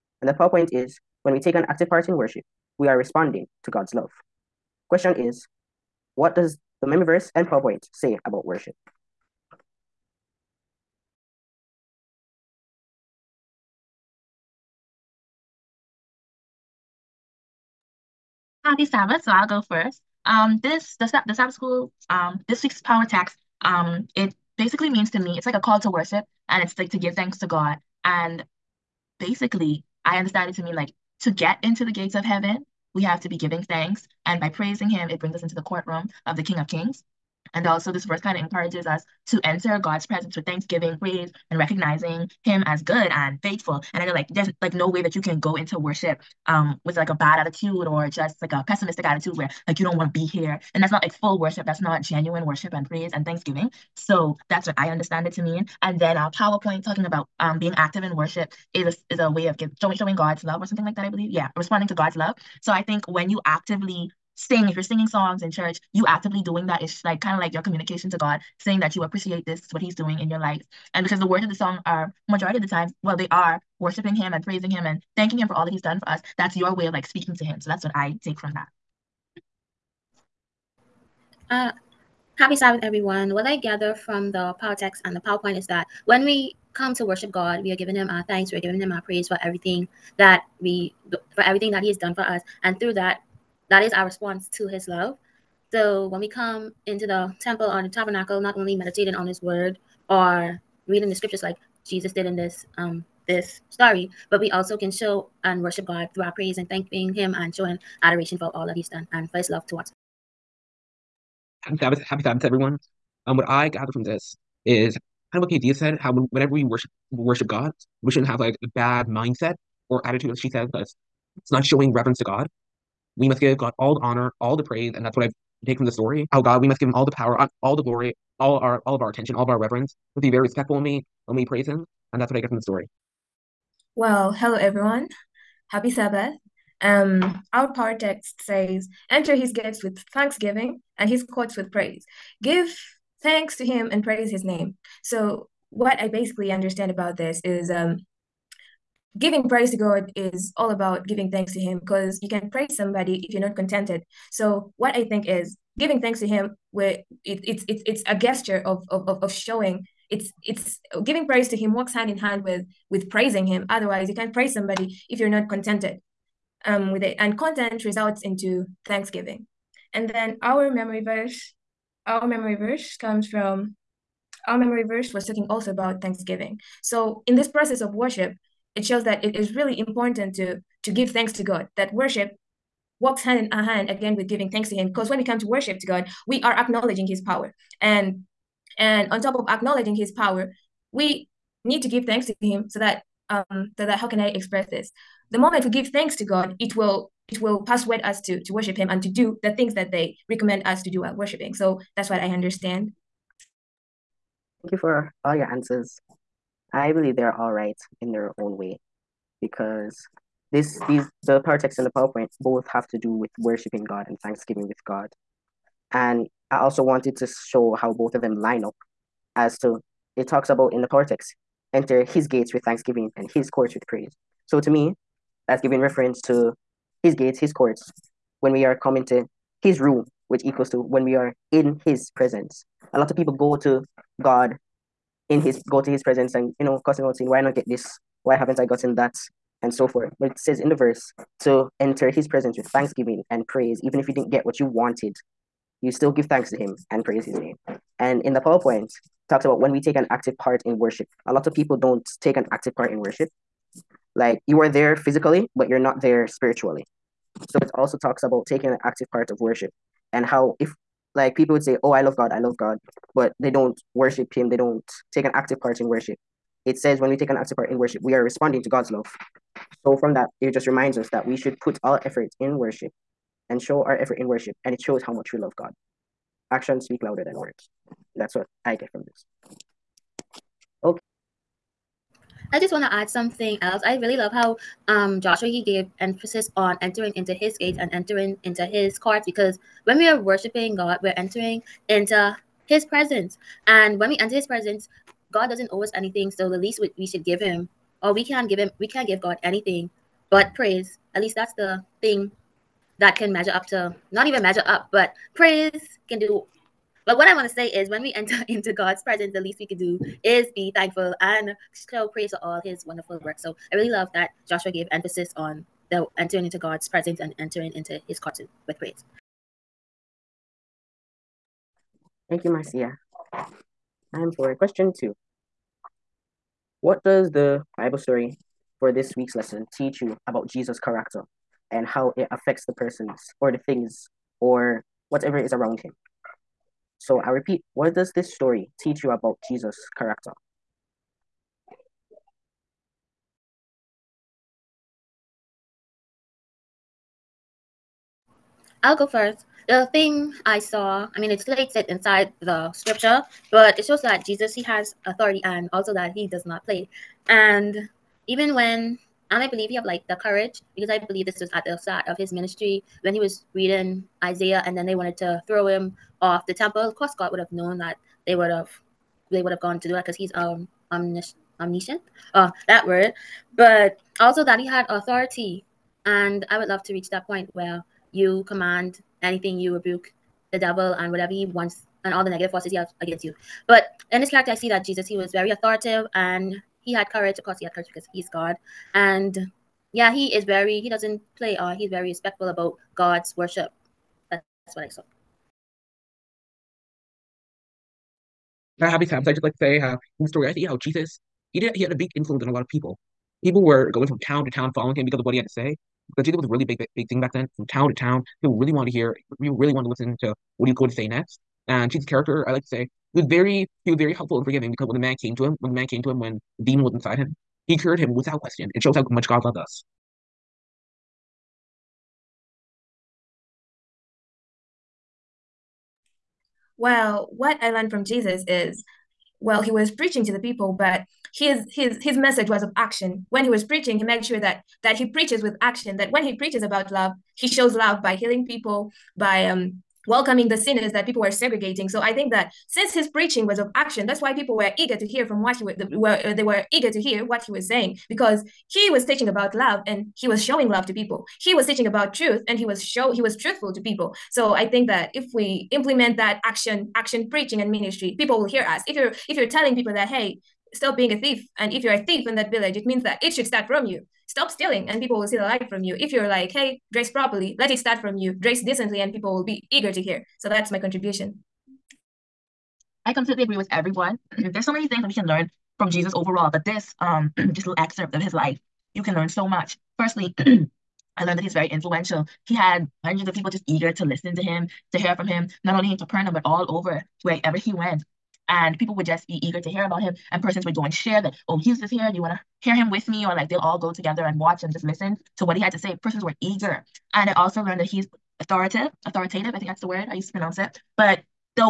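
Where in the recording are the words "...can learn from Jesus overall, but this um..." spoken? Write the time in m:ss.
7:55.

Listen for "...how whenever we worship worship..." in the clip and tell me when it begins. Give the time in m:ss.
1:55.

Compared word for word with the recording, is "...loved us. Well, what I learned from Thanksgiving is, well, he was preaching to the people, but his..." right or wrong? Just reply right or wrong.
wrong.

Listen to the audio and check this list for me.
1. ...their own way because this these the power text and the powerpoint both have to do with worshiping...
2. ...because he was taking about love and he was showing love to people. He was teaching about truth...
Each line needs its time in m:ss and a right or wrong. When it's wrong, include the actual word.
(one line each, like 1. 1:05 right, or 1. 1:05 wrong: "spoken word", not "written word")
1. 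3:28 right
2. 7:28 wrong: "teaching", not "taking".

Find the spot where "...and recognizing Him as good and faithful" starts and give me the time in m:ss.
0:41.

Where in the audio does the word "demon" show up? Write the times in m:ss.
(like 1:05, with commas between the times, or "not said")
6:56.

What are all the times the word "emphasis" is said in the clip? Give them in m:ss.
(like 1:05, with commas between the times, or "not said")
4:45, 5:14.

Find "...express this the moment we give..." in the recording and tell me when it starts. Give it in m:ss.
3:14.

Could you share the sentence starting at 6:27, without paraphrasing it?
Of course, he had courage because he's God.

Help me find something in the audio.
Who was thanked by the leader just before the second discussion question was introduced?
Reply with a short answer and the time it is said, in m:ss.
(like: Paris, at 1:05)
Marcia, at 5:22.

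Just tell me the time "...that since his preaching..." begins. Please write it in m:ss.
7:22.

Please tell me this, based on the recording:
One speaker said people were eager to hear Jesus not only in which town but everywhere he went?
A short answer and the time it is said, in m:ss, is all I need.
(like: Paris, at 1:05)
Capernaum, at 8:05.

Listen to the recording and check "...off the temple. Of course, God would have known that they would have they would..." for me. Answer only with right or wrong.
right.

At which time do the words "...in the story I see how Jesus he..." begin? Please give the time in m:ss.
6:40.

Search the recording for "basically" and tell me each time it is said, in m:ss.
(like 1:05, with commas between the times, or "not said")
0:24, 0:29, 2:26.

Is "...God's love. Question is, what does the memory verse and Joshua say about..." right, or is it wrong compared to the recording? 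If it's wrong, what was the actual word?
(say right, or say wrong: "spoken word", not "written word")
wrong: "PowerPoint", not "Joshua".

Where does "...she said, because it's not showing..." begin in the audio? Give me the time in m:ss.
2:00.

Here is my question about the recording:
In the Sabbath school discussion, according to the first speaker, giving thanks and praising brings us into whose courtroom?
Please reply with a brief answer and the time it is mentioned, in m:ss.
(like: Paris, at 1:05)
King of Kings, at 0:36.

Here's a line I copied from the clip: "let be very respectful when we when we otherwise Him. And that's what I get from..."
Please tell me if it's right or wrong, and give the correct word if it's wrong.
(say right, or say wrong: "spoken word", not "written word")
wrong: "praise", not "otherwise".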